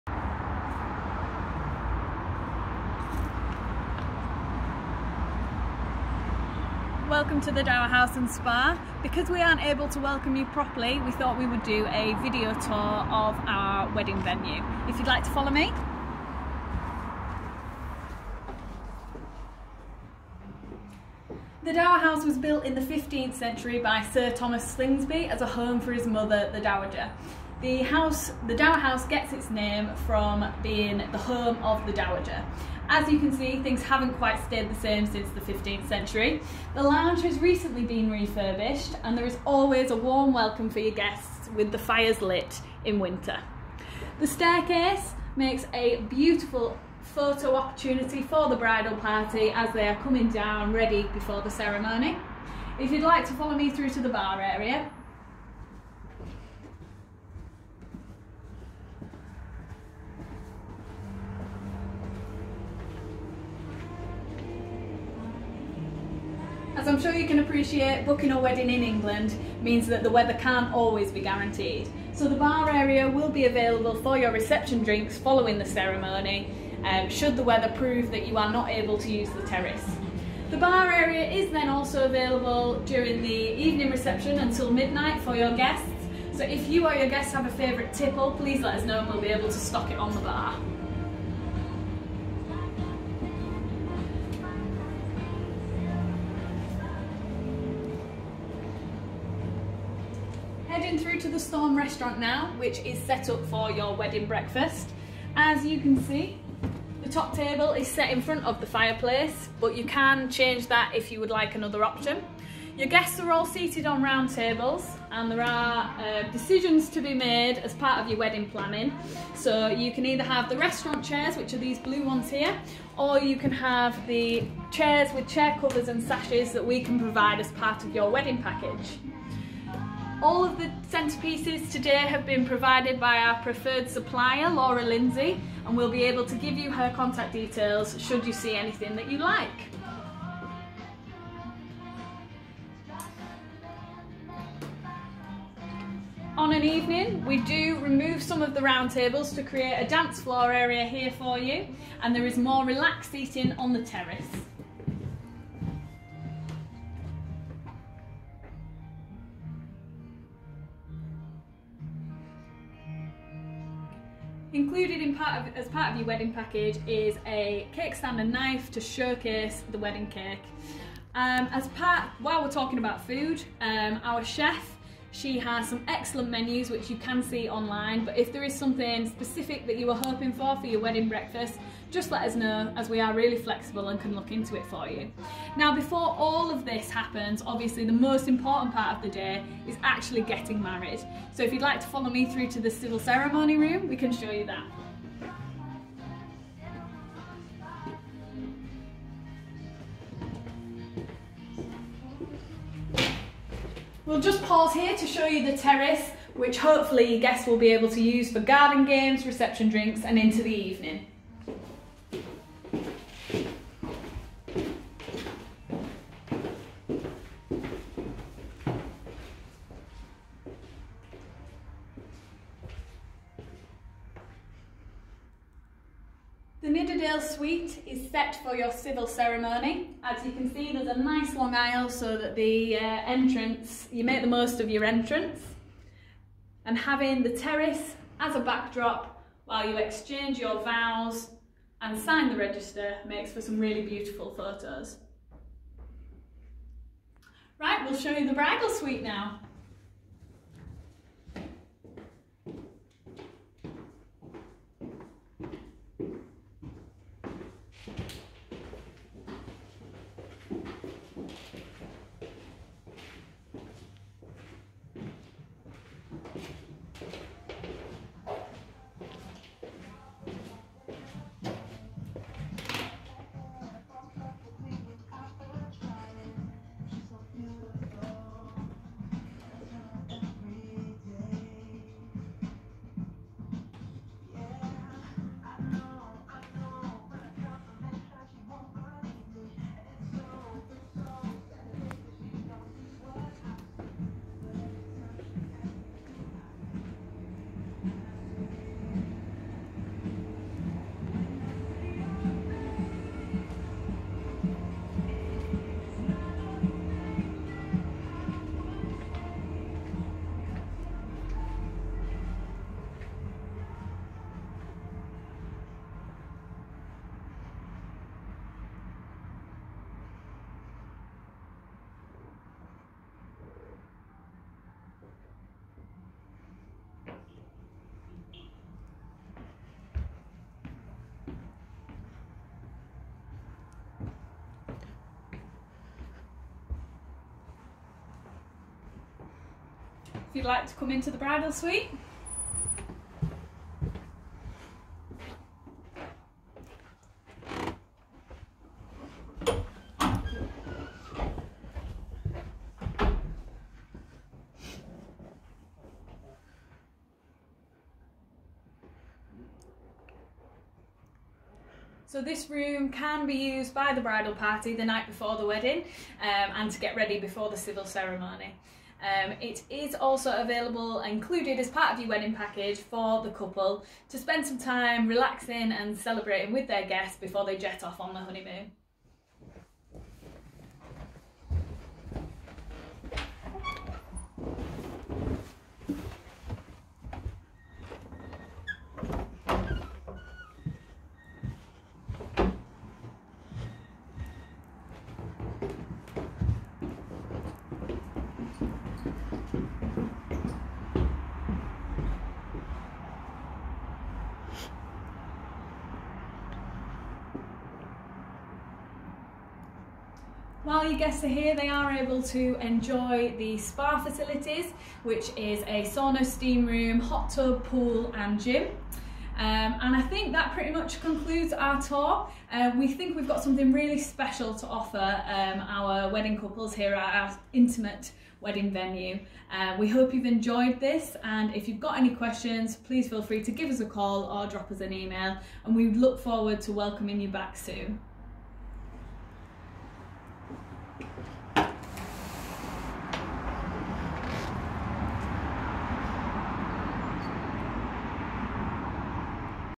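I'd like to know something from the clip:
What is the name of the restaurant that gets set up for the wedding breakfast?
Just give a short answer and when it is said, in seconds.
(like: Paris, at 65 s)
Storm restaurant, at 101 s.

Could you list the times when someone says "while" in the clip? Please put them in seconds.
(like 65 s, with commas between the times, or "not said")
172 s, 239 s, 410 s.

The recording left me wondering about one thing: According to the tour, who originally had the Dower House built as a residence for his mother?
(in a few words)
Sir Thomas Slingsby.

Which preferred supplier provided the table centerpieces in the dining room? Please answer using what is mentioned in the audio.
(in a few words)
Laura Lindsay.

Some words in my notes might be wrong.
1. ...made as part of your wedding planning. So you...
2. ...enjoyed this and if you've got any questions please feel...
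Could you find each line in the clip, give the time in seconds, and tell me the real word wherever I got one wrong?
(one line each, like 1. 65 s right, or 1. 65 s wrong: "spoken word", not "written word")
1. 117 s right
2. 430 s right.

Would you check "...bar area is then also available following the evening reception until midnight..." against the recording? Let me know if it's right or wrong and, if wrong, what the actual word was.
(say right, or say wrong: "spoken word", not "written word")
wrong: "during", not "following".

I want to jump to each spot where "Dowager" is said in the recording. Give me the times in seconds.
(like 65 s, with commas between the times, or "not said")
26 s, 31 s.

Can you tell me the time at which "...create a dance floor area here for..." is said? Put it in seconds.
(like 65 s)
149 s.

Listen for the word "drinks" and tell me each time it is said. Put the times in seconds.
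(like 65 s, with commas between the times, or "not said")
74 s, 209 s.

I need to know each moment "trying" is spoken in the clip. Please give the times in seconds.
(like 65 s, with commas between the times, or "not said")
not said.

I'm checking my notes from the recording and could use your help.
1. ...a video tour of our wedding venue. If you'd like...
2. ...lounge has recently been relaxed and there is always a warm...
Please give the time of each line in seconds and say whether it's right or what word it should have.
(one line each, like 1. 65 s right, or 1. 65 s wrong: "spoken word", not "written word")
1. 11 s right
2. 36 s wrong: "refurbished", not "relaxed".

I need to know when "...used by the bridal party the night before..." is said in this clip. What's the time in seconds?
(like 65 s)
363 s.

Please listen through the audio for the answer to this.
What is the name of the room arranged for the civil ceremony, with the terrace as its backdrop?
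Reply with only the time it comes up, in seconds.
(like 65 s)
226 s.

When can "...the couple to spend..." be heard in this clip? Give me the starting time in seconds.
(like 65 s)
373 s.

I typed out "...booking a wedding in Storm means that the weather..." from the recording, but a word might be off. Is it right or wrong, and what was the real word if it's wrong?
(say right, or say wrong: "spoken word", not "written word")
wrong: "England", not "Storm".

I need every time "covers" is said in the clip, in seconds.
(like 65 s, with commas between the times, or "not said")
125 s.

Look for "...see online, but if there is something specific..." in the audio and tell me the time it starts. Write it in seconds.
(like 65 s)
177 s.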